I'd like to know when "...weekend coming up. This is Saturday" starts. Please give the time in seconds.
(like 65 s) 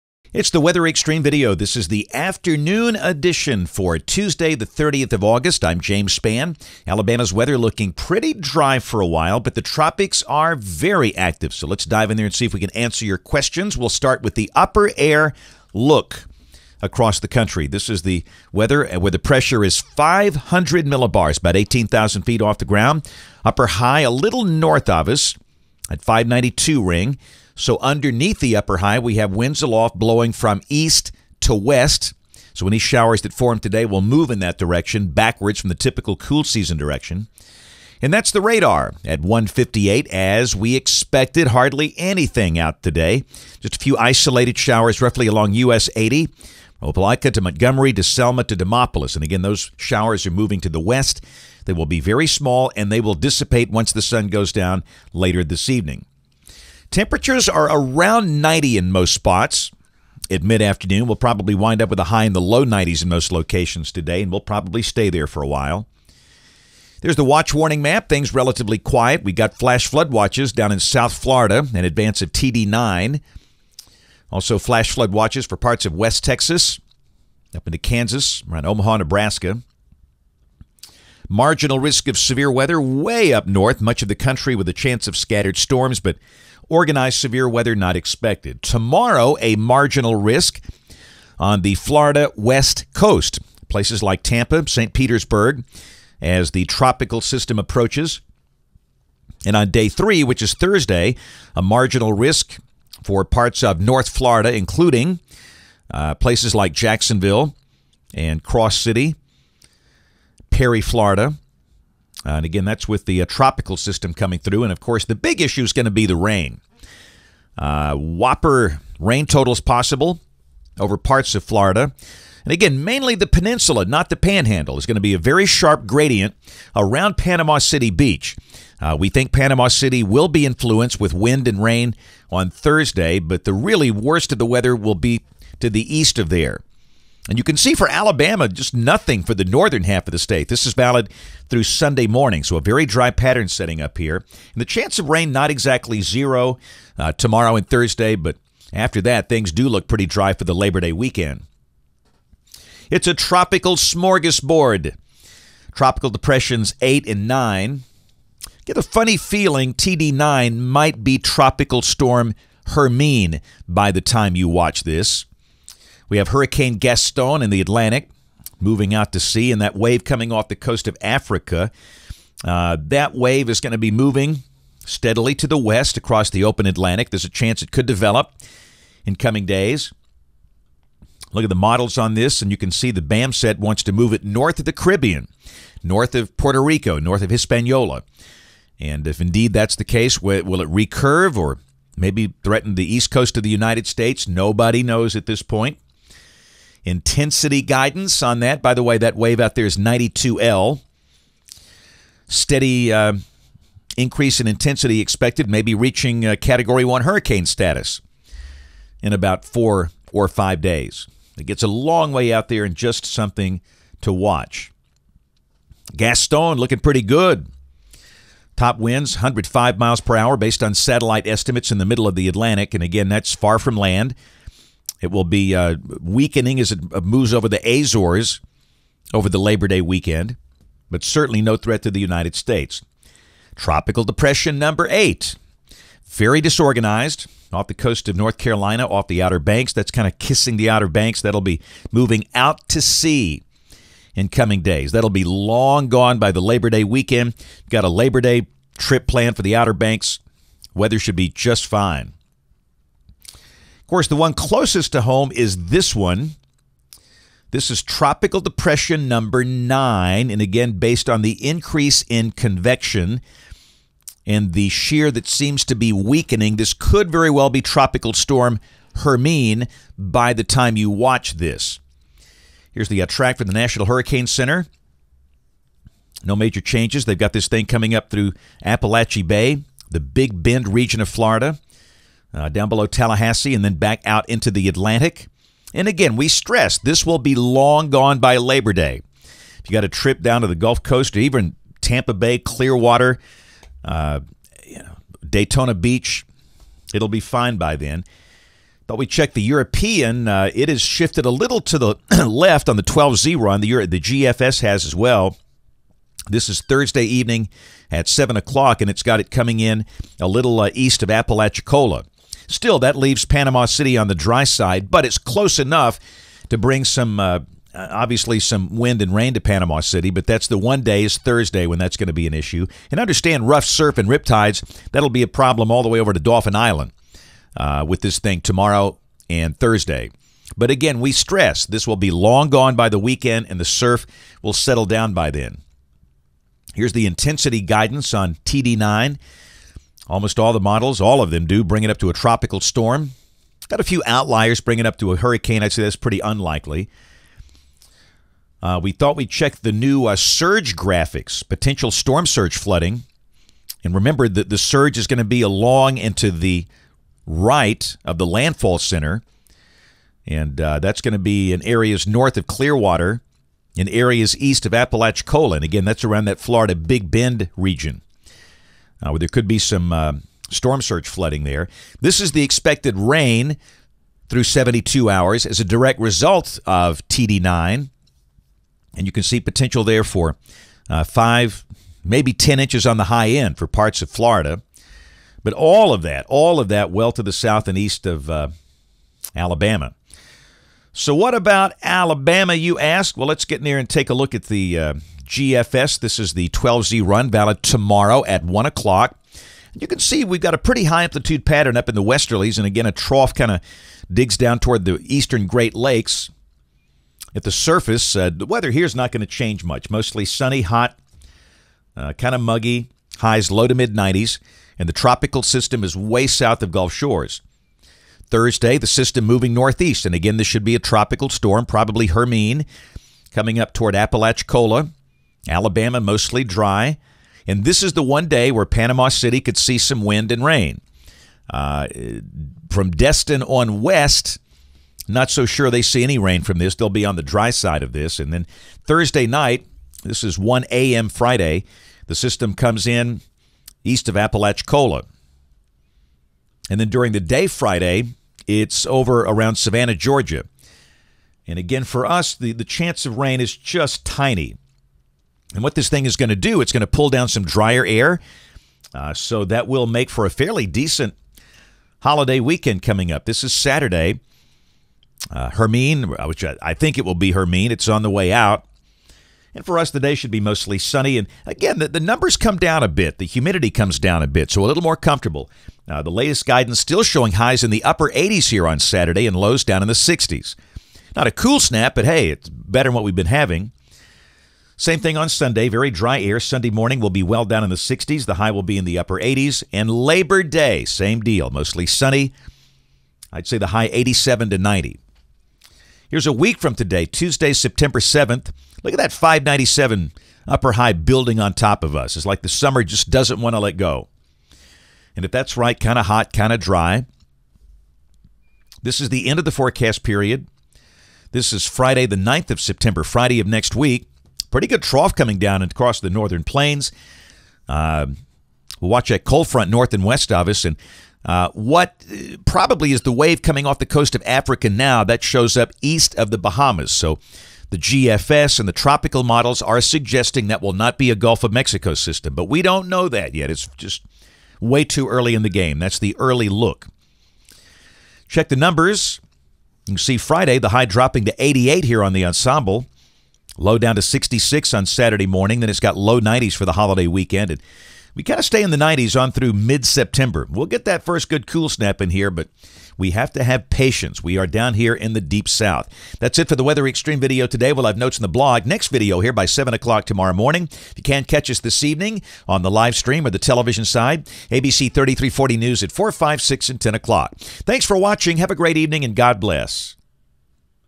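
462 s.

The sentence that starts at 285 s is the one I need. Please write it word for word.
And again, we stress this will be long gone by Labor Day.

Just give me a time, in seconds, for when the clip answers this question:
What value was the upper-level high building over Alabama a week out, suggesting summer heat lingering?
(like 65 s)
499 s.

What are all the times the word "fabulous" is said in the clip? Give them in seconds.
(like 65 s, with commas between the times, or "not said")
not said.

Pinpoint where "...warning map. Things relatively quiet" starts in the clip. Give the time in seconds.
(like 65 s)
67 s.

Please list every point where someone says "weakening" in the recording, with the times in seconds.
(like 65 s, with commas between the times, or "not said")
225 s, 265 s.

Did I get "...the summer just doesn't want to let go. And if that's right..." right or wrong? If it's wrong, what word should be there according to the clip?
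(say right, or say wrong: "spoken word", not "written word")
right.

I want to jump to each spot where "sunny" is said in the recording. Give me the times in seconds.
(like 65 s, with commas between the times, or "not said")
410 s, 470 s, 491 s.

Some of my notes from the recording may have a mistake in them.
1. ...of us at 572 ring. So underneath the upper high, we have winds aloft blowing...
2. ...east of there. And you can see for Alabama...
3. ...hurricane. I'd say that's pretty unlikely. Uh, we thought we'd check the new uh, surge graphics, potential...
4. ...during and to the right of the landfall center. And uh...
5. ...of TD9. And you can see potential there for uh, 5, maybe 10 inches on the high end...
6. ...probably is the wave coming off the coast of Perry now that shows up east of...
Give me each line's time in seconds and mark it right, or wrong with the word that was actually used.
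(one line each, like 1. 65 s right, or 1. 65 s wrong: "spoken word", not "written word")
1. 24 s wrong: "592", not "572"
2. 135 s right
3. 345 s right
4. 355 s wrong: "along", not "during"
5. 376 s right
6. 522 s wrong: "Africa", not "Perry".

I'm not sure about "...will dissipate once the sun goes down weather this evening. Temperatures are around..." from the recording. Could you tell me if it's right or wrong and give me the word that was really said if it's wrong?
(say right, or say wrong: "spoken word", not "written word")
wrong: "later", not "weather".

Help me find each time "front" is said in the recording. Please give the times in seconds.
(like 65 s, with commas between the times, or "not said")
519 s.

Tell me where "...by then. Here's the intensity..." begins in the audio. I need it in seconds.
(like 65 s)
335 s.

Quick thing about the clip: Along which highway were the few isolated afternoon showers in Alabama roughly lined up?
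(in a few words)
US 80.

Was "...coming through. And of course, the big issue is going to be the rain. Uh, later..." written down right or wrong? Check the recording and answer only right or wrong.
wrong.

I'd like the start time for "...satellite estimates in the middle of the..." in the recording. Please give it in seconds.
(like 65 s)
220 s.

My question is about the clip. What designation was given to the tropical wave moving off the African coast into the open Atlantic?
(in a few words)
92L.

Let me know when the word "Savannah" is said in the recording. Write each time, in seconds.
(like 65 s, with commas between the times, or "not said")
449 s.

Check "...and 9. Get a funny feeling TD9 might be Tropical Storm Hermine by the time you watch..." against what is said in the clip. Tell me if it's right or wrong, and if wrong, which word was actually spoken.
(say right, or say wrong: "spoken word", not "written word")
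right.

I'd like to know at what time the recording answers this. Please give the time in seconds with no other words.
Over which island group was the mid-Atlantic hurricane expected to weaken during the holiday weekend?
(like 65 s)
227 s.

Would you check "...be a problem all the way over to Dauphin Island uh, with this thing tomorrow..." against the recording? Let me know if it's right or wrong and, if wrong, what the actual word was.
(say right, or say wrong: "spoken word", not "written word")
right.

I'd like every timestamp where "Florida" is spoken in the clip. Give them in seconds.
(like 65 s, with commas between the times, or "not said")
71 s, 91 s, 104 s, 110 s, 121 s, 281 s, 366 s, 384 s.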